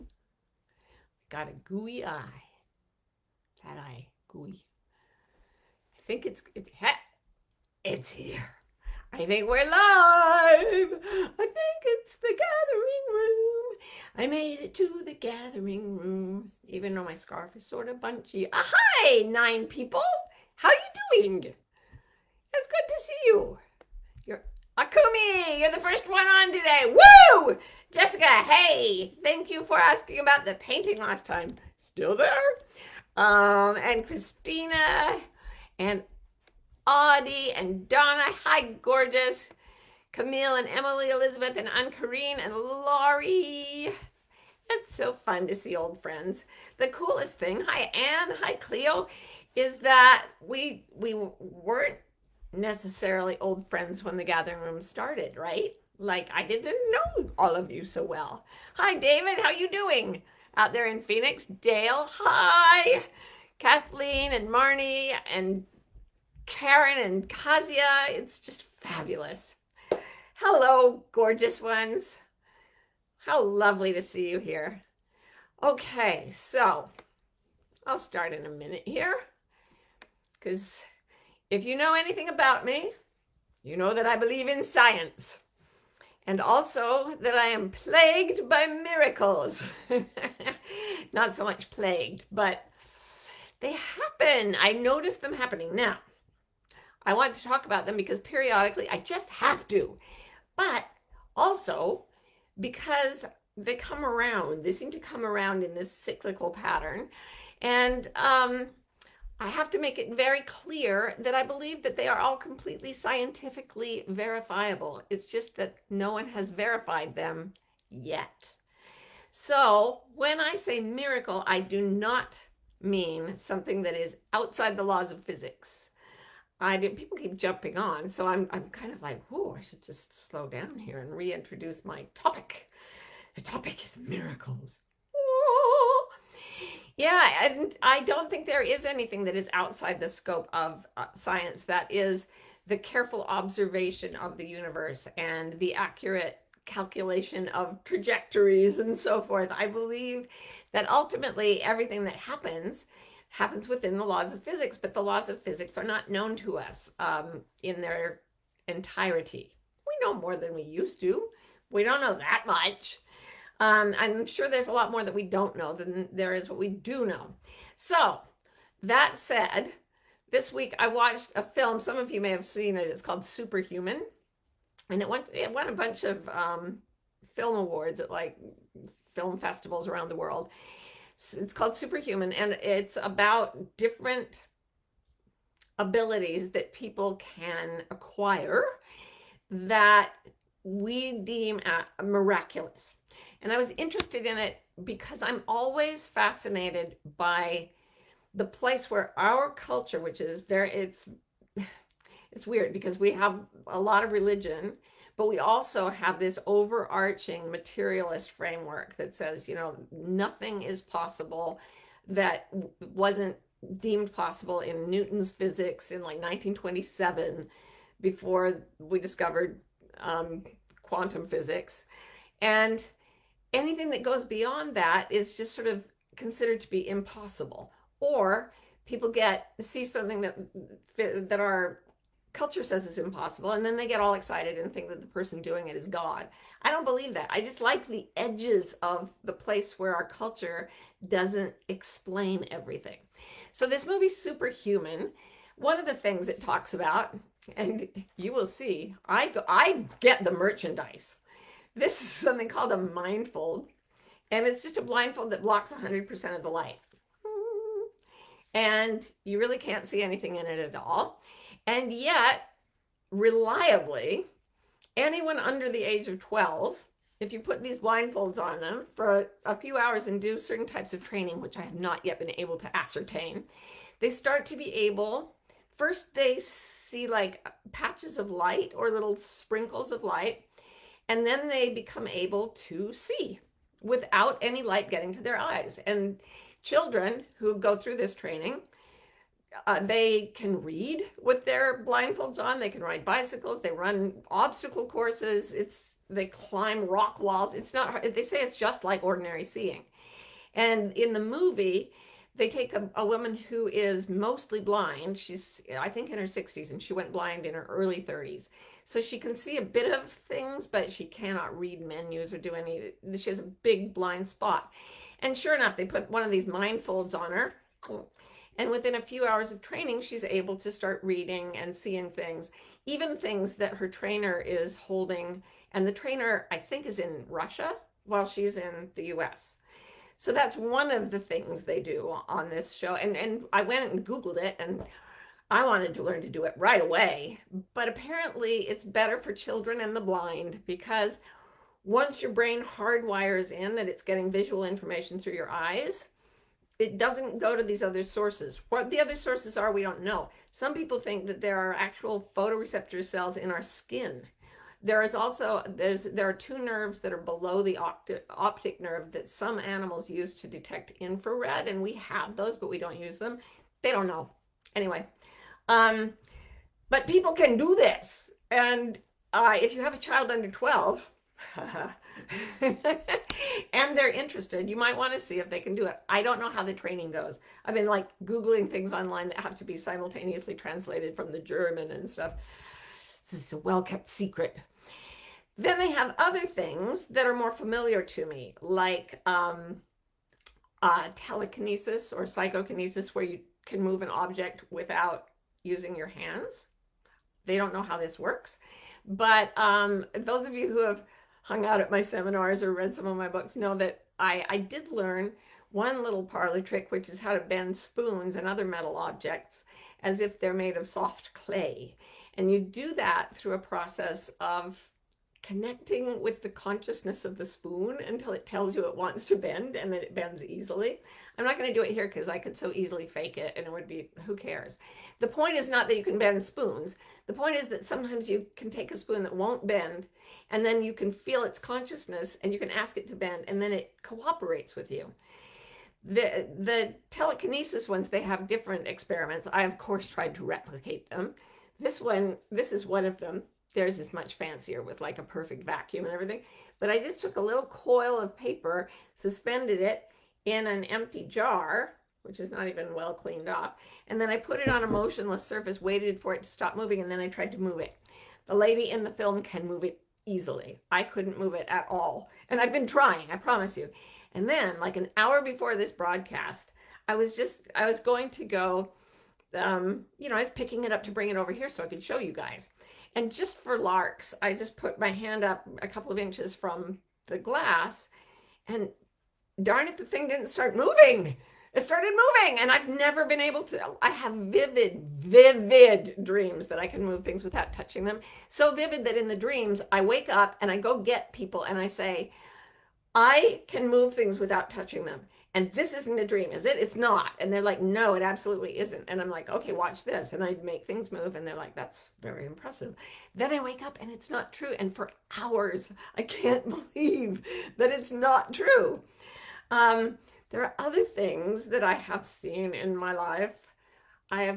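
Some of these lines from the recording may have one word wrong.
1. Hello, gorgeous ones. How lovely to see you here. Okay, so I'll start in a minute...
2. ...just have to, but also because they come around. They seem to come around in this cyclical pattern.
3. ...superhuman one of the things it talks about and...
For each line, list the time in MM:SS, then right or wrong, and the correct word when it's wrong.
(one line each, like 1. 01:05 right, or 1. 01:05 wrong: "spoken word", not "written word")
1. 01:10 right
2. 01:38 right
3. 04:04 right.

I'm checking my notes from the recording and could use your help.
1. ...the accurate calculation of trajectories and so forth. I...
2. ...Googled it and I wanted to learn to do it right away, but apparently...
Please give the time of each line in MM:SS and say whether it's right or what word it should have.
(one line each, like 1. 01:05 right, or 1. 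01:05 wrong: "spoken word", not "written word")
1. 02:25 right
2. 05:34 right.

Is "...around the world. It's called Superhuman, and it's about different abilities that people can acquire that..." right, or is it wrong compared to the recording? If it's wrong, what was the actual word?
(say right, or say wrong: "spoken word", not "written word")
right.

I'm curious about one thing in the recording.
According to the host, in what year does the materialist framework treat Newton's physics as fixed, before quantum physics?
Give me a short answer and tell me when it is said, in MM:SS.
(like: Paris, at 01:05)
1927, at 03:36.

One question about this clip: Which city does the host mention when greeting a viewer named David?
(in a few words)
Phoenix.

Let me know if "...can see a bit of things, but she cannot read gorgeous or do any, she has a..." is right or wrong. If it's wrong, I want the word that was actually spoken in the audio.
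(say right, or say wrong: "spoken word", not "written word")
wrong: "menus", not "gorgeous".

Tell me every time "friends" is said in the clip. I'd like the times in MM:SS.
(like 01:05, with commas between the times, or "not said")
00:45, 00:53.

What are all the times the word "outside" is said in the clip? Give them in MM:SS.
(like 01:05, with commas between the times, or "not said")
02:04, 02:19.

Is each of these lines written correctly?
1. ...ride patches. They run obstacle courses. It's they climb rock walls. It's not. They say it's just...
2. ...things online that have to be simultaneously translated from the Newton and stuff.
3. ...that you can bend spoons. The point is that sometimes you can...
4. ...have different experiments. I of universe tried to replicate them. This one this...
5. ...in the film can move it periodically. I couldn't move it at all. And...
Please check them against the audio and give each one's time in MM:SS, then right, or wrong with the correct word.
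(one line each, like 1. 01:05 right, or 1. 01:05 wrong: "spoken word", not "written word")
1. 04:52 wrong: "bicycles", not "patches"
2. 06:18 wrong: "German", not "Newton"
3. 07:05 right
4. 07:18 wrong: "course", not "universe"
5. 07:38 wrong: "easily", not "periodically".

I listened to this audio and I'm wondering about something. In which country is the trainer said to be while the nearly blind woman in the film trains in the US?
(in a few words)
Russia.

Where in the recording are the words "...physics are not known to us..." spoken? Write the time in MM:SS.
02:35.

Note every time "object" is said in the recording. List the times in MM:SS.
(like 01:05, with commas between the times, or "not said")
06:34, 06:48.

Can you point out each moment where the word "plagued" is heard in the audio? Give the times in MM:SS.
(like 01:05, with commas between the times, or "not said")
01:27, 01:31.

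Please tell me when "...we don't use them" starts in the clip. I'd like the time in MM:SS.
06:02.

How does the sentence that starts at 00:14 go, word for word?
I made it to the gathering room, even though my scarf is sort of bunchy.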